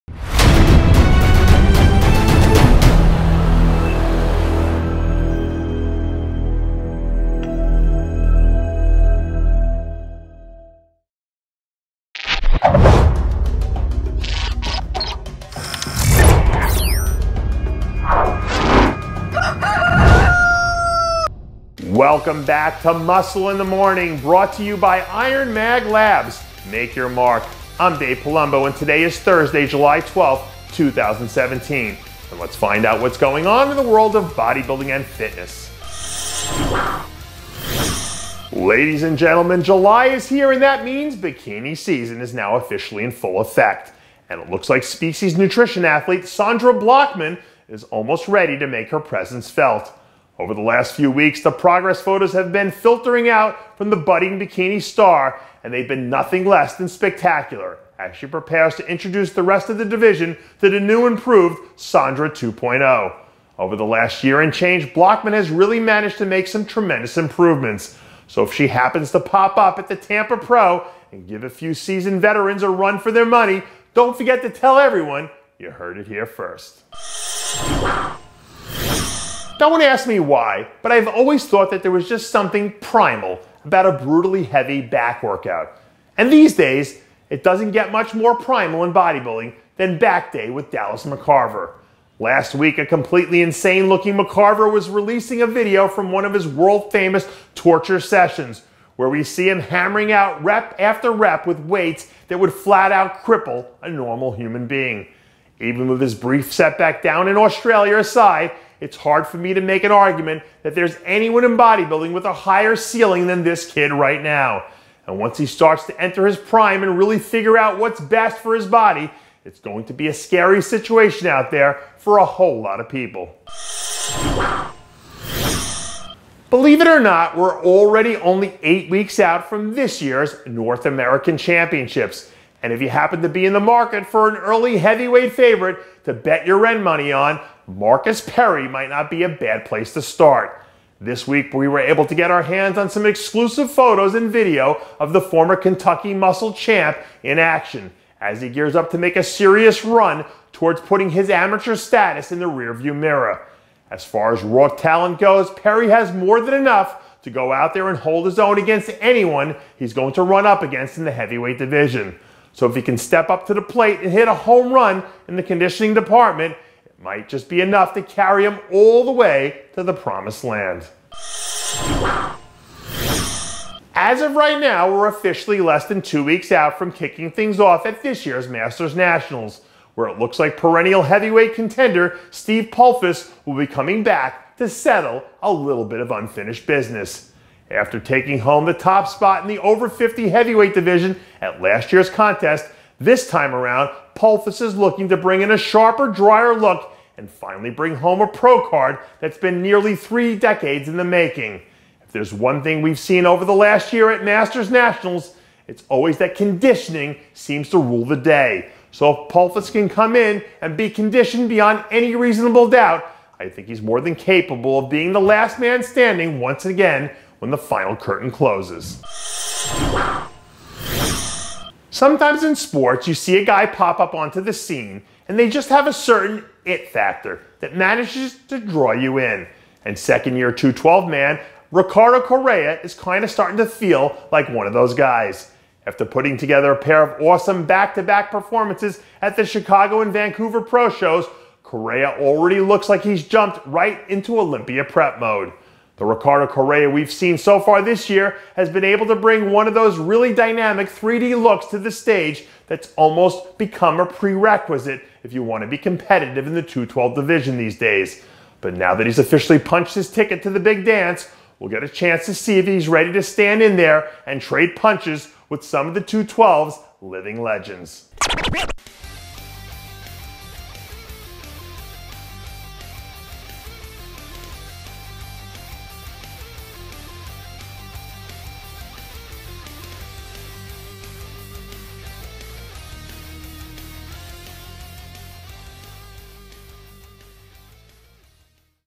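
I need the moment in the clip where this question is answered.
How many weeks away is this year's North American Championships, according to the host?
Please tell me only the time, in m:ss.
2:08.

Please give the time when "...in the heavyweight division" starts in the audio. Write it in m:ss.
2:40.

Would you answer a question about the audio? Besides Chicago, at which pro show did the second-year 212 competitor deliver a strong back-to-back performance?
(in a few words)
Vancouver.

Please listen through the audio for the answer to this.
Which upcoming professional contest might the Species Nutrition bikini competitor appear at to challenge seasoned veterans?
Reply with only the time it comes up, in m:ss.
1:09.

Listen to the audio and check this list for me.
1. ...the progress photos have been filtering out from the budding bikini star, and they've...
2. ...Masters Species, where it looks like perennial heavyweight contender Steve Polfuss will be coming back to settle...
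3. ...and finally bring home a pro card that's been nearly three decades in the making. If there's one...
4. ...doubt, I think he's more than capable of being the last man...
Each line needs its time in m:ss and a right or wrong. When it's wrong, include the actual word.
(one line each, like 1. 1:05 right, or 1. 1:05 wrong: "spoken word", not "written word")
1. 0:51 right
2. 2:58 wrong: "Nationals", not "Species"
3. 3:17 right
4. 3:32 right.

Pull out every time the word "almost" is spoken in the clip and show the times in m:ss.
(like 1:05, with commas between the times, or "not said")
0:47, 4:12.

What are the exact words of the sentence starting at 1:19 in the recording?
Don't want to ask me why, but I've always thought that there was just something primal about a brutally heavy back workout.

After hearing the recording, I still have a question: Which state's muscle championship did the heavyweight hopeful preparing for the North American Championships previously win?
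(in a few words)
Kentucky.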